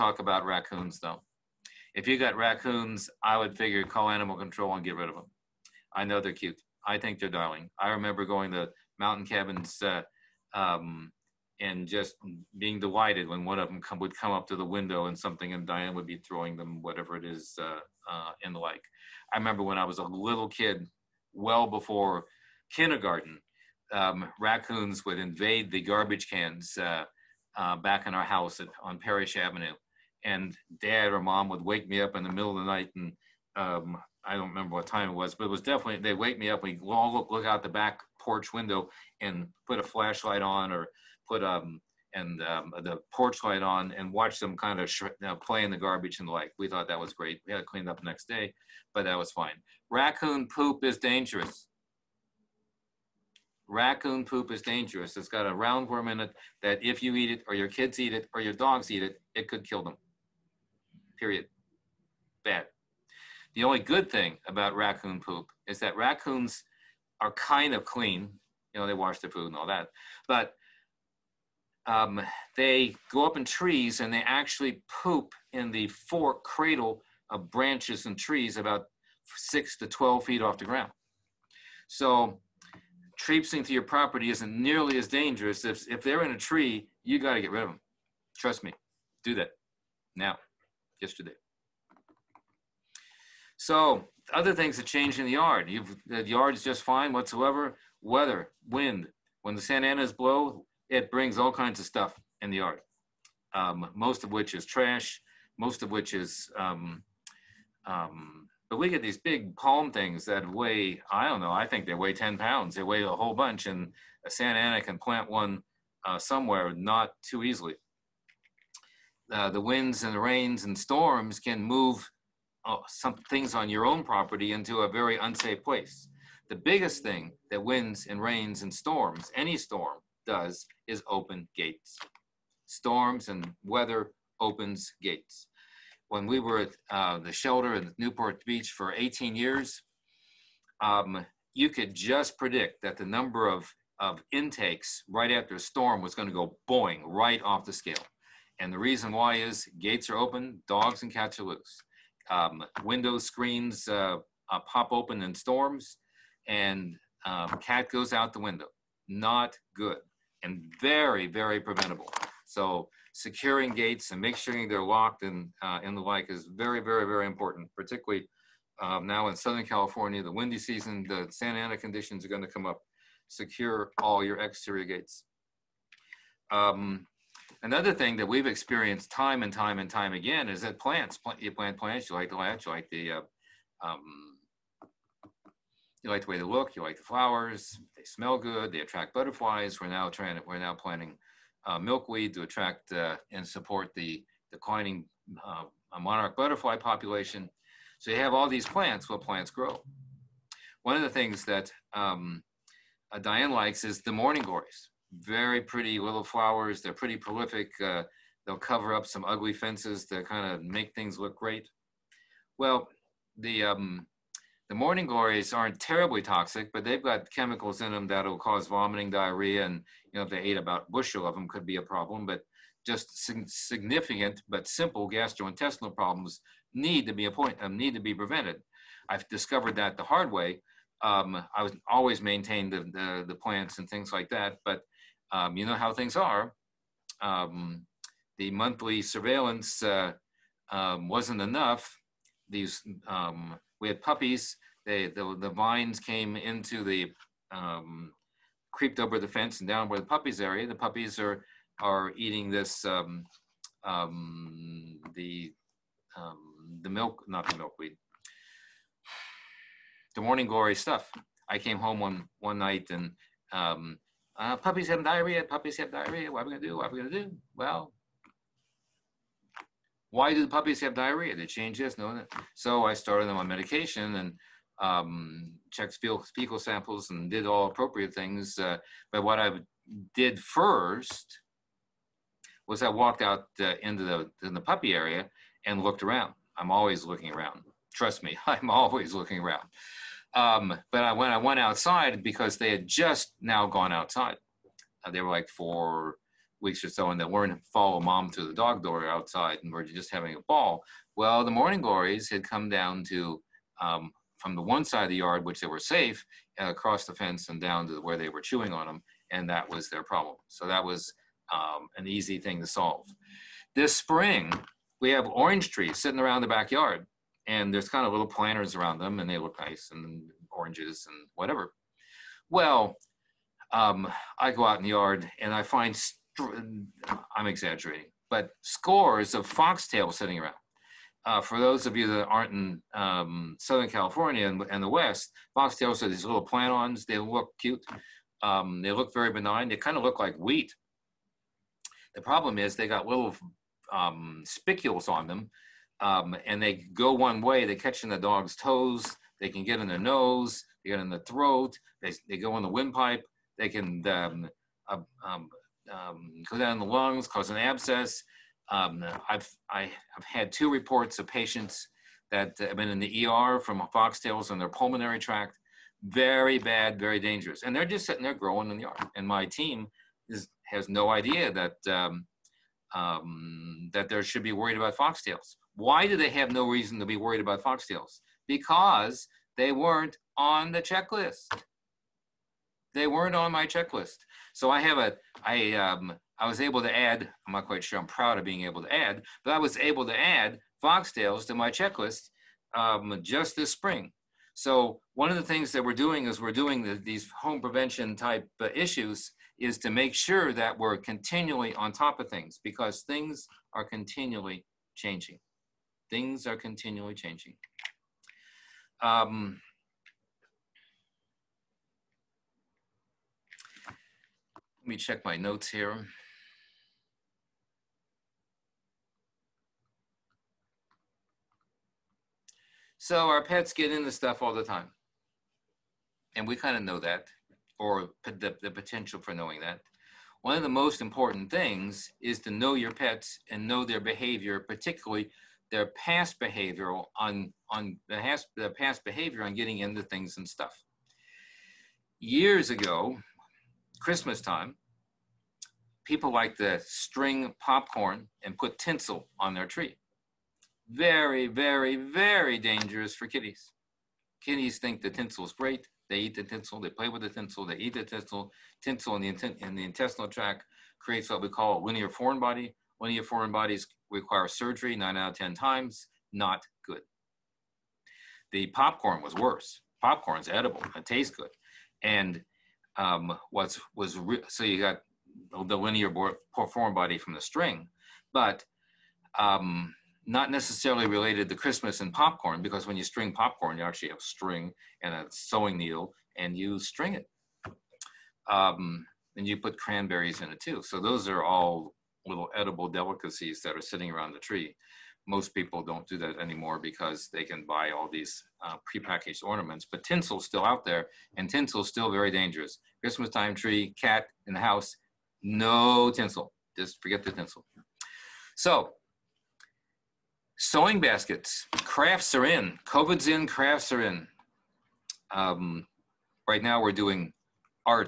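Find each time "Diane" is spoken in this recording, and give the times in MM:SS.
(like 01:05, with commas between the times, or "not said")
00:15, 03:23.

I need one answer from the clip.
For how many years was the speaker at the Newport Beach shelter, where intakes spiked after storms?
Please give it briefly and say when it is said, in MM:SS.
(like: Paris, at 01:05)
18, at 02:18.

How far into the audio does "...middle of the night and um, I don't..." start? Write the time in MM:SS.
00:32.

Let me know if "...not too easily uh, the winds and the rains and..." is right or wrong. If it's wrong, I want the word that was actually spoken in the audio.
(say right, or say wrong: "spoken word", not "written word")
right.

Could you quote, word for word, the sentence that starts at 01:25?
If, if they're in a tree, you got to get rid of them.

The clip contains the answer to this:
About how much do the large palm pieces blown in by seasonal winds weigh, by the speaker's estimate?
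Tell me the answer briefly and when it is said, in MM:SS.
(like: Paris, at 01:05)
10 pounds, at 01:52.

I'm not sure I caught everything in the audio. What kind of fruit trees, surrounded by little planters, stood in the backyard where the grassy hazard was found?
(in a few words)
Orange.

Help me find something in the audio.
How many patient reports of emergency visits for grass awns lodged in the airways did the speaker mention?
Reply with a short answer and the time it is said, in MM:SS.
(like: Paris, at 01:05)
2, at 06:00.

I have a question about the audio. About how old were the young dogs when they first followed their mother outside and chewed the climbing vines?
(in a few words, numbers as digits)
4 weeks.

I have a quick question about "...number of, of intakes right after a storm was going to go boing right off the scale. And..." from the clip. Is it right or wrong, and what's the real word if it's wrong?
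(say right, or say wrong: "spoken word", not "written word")
right.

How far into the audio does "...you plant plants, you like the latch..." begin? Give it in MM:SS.
03:01.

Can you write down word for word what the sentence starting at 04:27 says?
Well, why do the puppies have diarrhea?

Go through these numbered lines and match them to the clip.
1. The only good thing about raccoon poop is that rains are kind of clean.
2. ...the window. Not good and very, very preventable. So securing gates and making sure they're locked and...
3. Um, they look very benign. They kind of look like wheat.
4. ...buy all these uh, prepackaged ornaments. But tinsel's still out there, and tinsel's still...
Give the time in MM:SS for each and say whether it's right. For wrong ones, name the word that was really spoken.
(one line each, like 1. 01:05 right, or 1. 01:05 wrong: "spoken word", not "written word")
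1. 01:03 wrong: "raccoons", not "rains"
2. 02:38 right
3. 05:38 right
4. 08:17 right.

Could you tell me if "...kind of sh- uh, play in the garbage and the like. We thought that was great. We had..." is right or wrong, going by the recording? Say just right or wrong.
right.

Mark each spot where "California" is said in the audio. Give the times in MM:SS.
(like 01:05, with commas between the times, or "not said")
02:49, 05:33.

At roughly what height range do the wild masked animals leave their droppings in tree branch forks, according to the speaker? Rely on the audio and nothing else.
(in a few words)
6 to 12 feet.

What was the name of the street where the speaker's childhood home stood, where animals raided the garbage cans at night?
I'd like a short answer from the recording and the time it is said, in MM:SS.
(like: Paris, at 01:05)
Parish Avenue, at 00:28.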